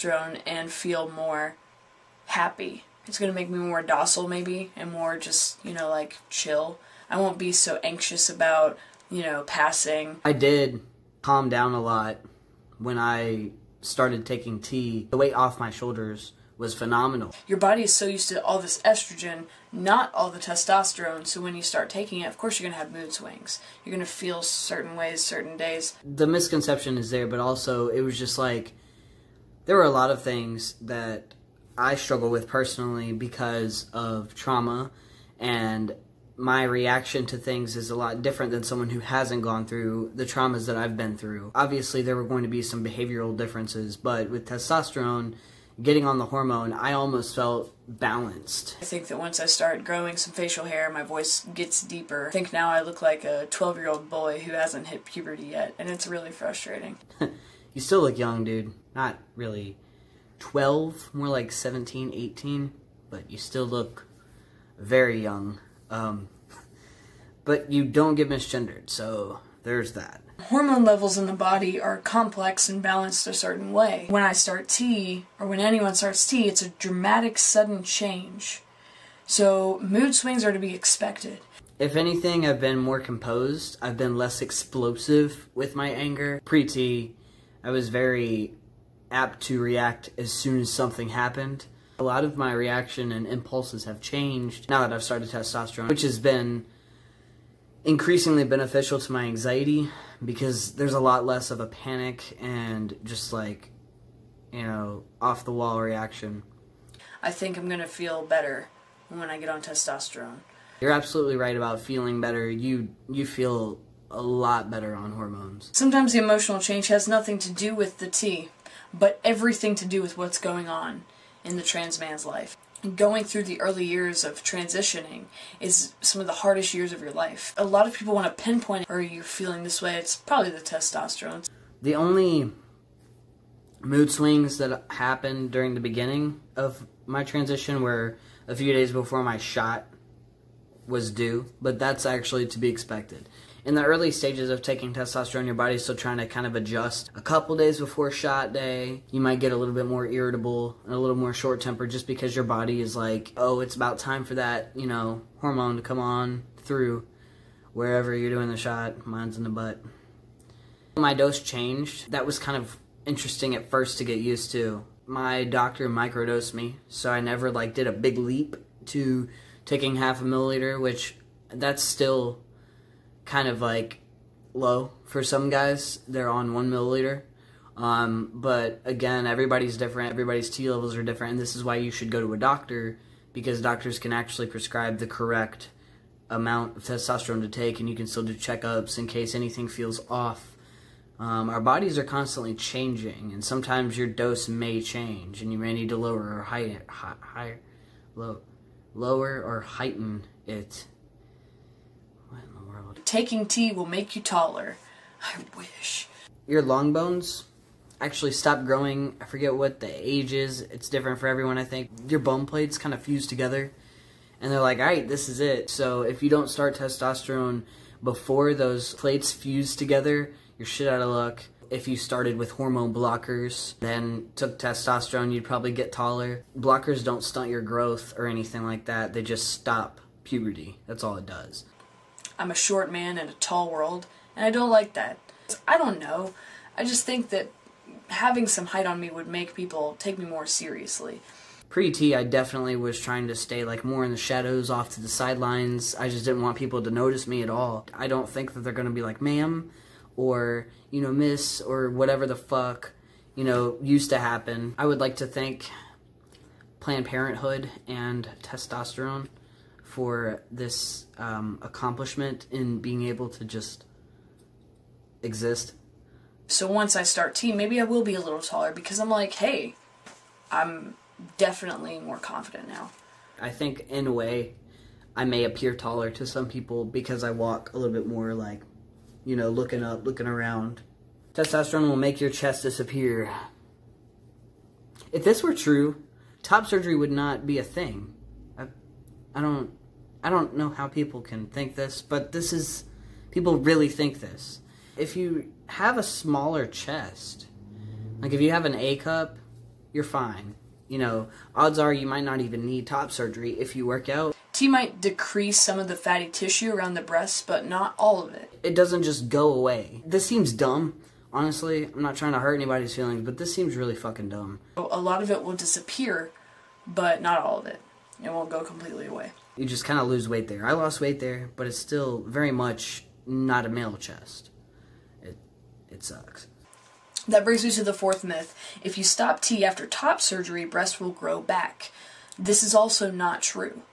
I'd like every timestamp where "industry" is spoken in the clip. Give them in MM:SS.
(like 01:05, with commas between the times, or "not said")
not said.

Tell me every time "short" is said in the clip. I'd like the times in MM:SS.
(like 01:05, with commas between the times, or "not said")
02:31, 03:52.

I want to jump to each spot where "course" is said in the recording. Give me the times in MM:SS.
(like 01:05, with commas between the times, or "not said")
00:22.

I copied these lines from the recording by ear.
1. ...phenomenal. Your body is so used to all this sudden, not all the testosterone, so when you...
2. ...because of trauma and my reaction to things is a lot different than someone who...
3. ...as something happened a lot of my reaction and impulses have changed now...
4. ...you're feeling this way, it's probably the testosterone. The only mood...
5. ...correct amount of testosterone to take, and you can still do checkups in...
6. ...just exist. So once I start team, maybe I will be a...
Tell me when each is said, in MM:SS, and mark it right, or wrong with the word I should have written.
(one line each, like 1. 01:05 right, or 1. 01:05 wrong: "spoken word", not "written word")
1. 00:16 wrong: "estrogen", not "sudden"
2. 00:33 right
3. 01:30 right
4. 02:09 right
5. 03:05 right
6. 04:23 right.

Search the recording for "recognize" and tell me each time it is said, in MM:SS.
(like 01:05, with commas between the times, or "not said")
not said.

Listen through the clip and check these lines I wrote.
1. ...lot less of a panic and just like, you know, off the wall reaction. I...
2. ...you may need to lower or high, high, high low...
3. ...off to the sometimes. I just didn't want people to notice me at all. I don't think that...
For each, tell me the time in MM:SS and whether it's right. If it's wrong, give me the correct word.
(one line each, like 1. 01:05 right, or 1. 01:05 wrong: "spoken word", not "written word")
1. 01:40 right
2. 03:15 right
3. 04:04 wrong: "sidelines", not "sometimes".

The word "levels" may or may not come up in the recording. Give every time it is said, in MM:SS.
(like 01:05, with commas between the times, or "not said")
01:10, 03:00.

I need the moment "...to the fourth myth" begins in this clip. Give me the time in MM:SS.
05:27.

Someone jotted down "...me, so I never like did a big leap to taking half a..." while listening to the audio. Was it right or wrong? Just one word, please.
right.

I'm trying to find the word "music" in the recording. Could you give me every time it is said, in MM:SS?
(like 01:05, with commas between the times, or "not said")
not said.